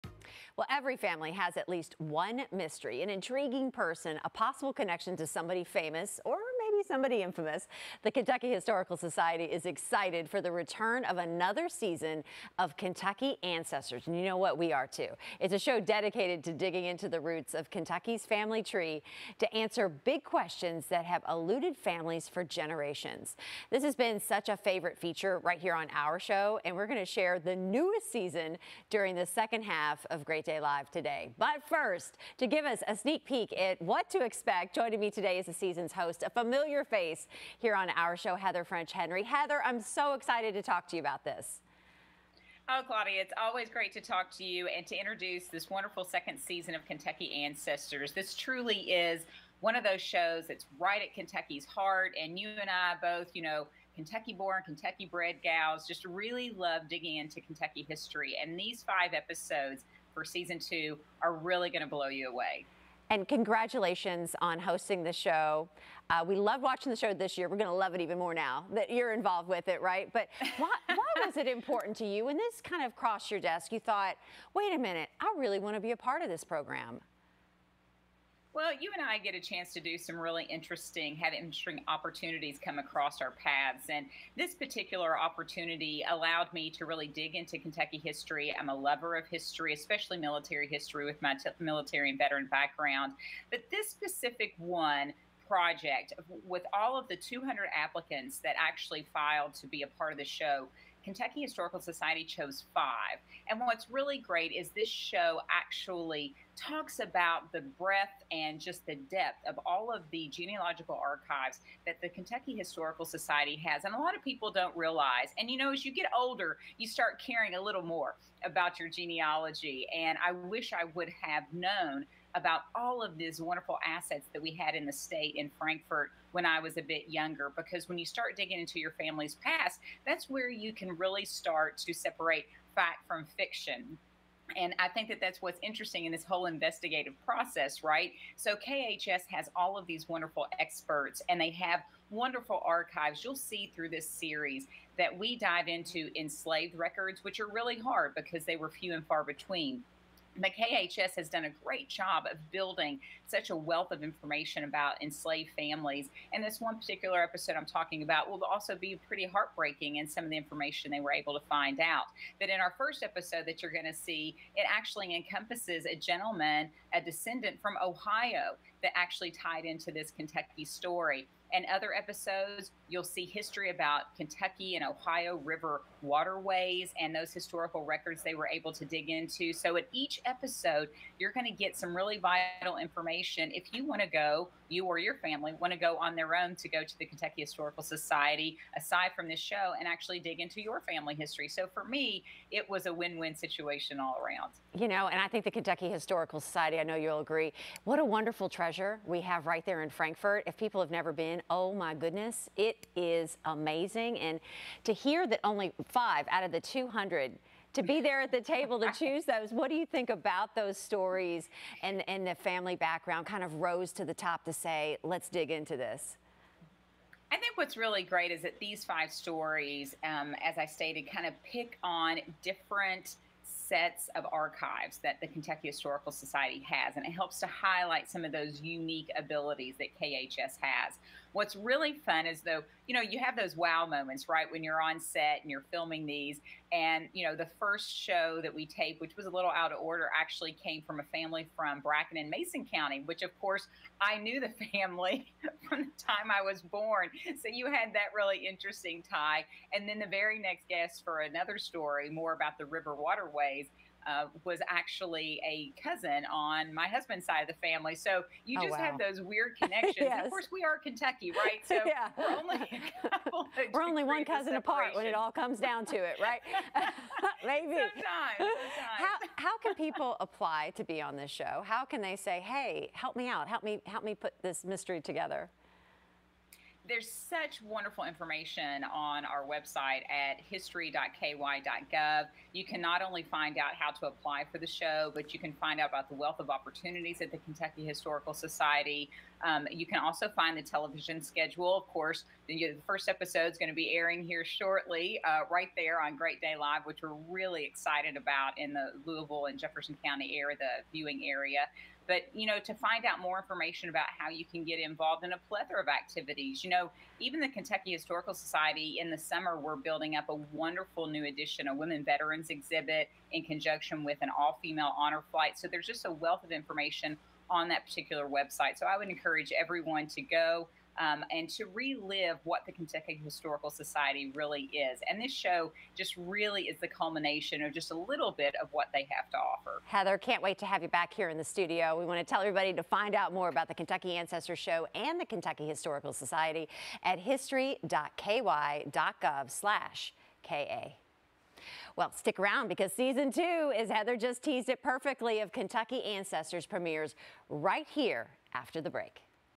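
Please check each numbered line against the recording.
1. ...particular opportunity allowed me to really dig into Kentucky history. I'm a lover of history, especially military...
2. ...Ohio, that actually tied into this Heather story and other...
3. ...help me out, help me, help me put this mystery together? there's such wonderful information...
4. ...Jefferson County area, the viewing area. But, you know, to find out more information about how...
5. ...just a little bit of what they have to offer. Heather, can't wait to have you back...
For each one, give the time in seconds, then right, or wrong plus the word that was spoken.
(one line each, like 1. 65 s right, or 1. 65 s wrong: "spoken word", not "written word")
1. 84 s right
2. 167 s wrong: "Kentucky", not "Heather"
3. 272 s right
4. 299 s right
5. 327 s right.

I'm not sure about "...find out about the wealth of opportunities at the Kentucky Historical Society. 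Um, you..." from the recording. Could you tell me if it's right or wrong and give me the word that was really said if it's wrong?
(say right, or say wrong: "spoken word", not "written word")
right.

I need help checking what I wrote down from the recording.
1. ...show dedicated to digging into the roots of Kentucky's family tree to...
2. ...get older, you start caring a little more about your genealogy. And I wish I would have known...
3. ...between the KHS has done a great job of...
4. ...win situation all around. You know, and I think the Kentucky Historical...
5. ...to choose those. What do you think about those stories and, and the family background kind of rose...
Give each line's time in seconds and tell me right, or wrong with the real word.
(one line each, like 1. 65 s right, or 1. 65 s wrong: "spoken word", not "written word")
1. 15 s right
2. 115 s right
3. 149 s right
4. 193 s right
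5. 208 s right.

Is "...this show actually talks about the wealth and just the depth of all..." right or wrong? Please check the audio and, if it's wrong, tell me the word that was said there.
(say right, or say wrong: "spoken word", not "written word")
wrong: "breadth", not "wealth".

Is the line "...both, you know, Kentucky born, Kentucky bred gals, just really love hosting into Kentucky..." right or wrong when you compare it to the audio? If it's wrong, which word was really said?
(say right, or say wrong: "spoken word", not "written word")
wrong: "digging", not "hosting".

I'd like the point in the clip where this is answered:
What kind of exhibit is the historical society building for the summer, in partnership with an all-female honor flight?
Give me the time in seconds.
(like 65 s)
311 s.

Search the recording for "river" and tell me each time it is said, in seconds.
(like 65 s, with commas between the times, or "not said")
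175 s, 252 s.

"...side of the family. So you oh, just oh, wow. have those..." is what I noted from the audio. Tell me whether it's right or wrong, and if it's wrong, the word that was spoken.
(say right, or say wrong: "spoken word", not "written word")
right.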